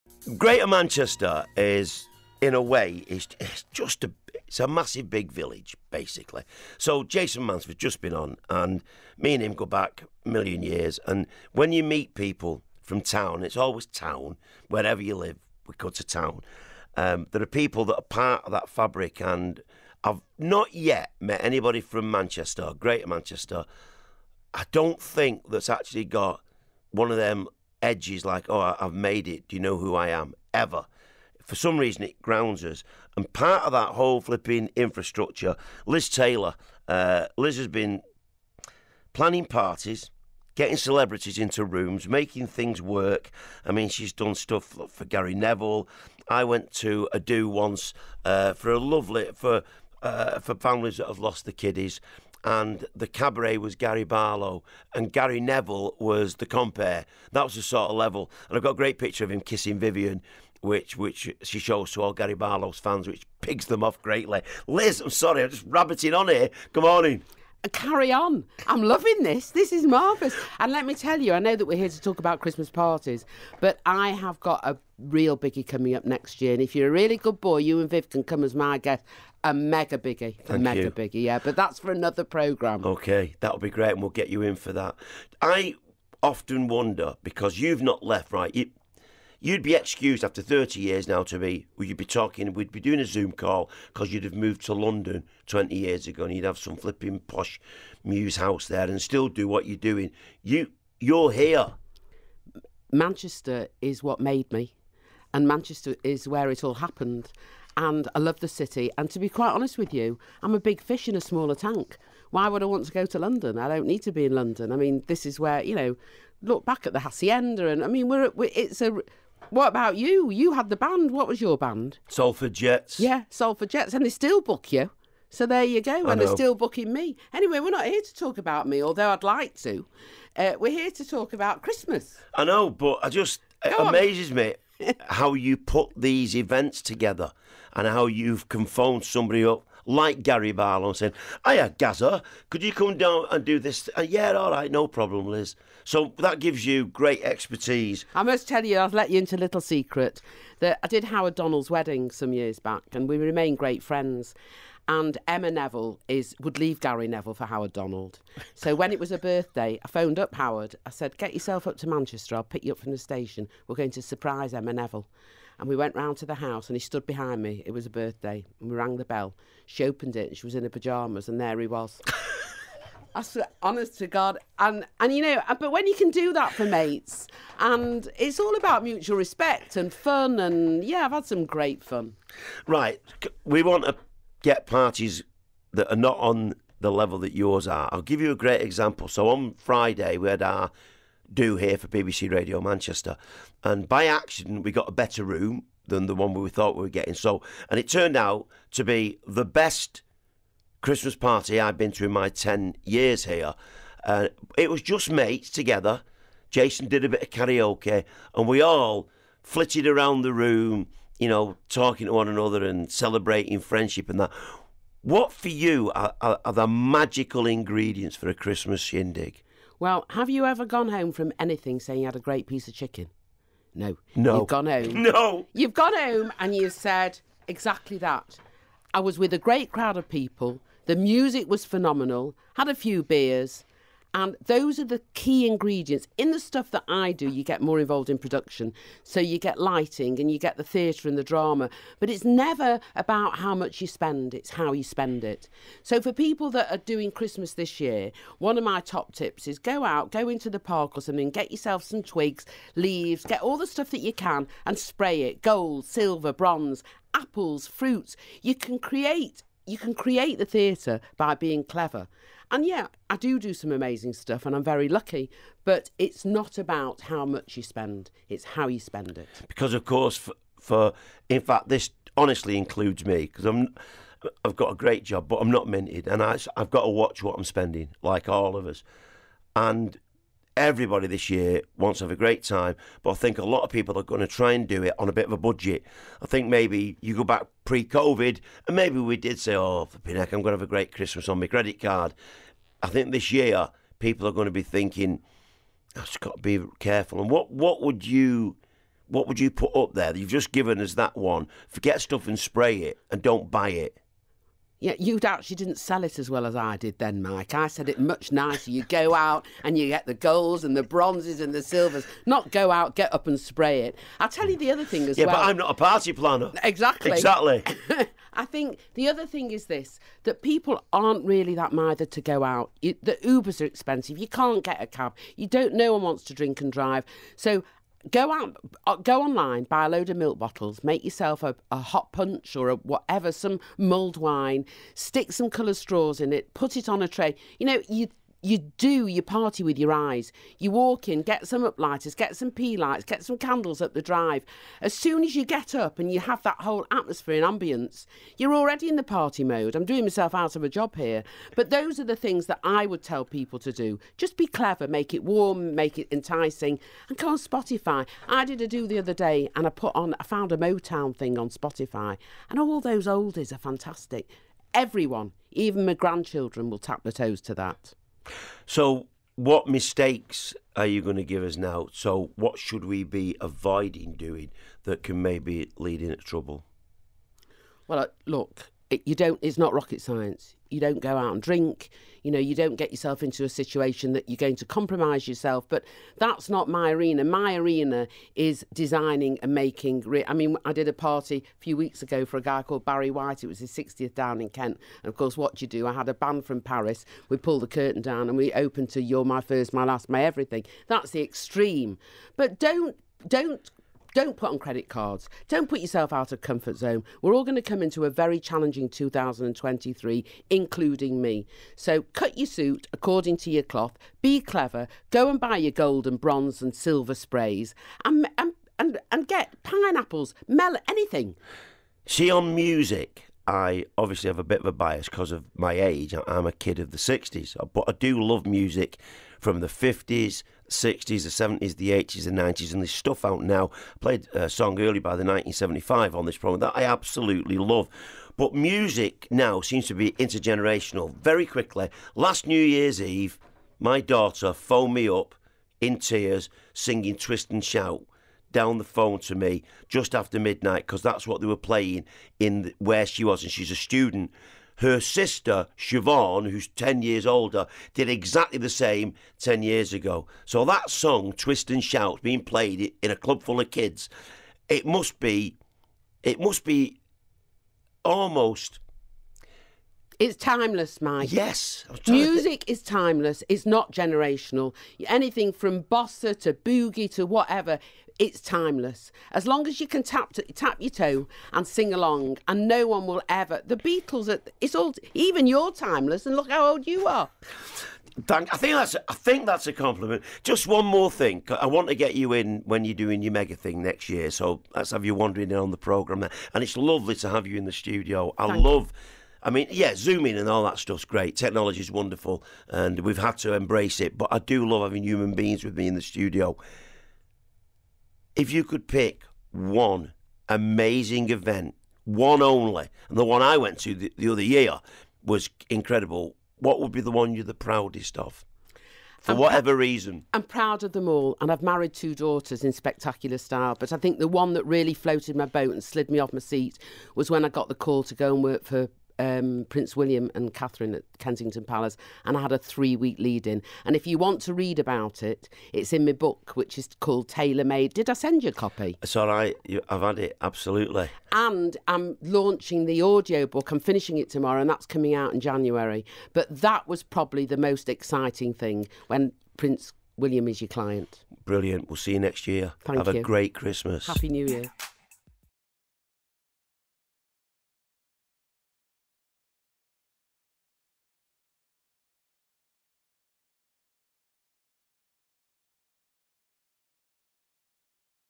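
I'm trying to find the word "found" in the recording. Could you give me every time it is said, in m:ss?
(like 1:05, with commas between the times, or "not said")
6:00.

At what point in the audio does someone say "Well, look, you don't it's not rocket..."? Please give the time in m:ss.
6:17.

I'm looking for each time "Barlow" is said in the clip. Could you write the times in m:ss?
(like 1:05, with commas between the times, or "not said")
0:54, 1:02, 2:20.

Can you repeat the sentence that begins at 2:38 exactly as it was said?
So when it was her birthday, I phoned up Howard.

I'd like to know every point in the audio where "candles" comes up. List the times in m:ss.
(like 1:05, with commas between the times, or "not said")
5:43.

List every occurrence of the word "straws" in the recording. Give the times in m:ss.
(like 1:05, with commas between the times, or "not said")
5:35.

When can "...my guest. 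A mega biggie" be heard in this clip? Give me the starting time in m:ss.
1:18.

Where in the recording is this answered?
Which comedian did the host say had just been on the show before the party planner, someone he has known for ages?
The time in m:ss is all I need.
0:07.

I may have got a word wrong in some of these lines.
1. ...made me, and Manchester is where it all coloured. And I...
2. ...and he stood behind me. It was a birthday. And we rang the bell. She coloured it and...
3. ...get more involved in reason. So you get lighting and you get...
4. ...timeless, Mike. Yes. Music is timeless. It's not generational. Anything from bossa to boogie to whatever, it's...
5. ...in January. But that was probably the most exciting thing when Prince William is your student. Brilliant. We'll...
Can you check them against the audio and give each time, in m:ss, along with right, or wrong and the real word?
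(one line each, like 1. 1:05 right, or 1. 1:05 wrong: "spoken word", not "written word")
1. 1:44 wrong: "happened", not "coloured"
2. 2:46 wrong: "opened", not "coloured"
3. 3:57 wrong: "production", not "reason"
4. 7:50 right
5. 9:05 wrong: "client", not "student".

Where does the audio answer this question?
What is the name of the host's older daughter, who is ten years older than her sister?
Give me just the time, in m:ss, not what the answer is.
7:35.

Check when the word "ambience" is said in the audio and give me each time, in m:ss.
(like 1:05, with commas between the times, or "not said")
5:47.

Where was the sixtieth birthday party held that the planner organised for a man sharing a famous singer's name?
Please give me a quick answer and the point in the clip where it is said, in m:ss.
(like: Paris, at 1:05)
Kent, at 6:34.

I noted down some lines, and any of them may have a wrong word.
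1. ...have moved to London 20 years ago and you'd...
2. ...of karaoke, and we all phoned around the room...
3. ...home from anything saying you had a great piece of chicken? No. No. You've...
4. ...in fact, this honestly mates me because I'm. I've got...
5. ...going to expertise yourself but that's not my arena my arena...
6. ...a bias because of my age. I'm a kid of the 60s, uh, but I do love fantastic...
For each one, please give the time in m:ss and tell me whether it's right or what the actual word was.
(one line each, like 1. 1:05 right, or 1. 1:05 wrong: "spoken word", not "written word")
1. 1:34 right
2. 3:27 wrong: "flitted", not "phoned"
3. 3:40 right
4. 4:31 wrong: "includes", not "mates"
5. 6:24 wrong: "compromise", not "expertise"
6. 7:04 wrong: "music", not "fantastic".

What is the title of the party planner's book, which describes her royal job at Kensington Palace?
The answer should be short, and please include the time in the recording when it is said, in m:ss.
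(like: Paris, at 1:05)
Tailor Made, at 8:57.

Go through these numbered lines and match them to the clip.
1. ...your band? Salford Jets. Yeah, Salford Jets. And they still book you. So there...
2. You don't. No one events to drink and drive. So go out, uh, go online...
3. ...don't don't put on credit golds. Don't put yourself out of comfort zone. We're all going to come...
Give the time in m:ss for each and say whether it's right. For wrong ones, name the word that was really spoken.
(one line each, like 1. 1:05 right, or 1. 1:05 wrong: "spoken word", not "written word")
1. 2:01 right
2. 5:25 wrong: "wants", not "events"
3. 6:43 wrong: "cards", not "golds".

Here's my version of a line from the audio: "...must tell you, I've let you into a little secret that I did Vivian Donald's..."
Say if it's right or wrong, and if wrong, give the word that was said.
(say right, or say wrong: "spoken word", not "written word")
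wrong: "Howard", not "Vivian".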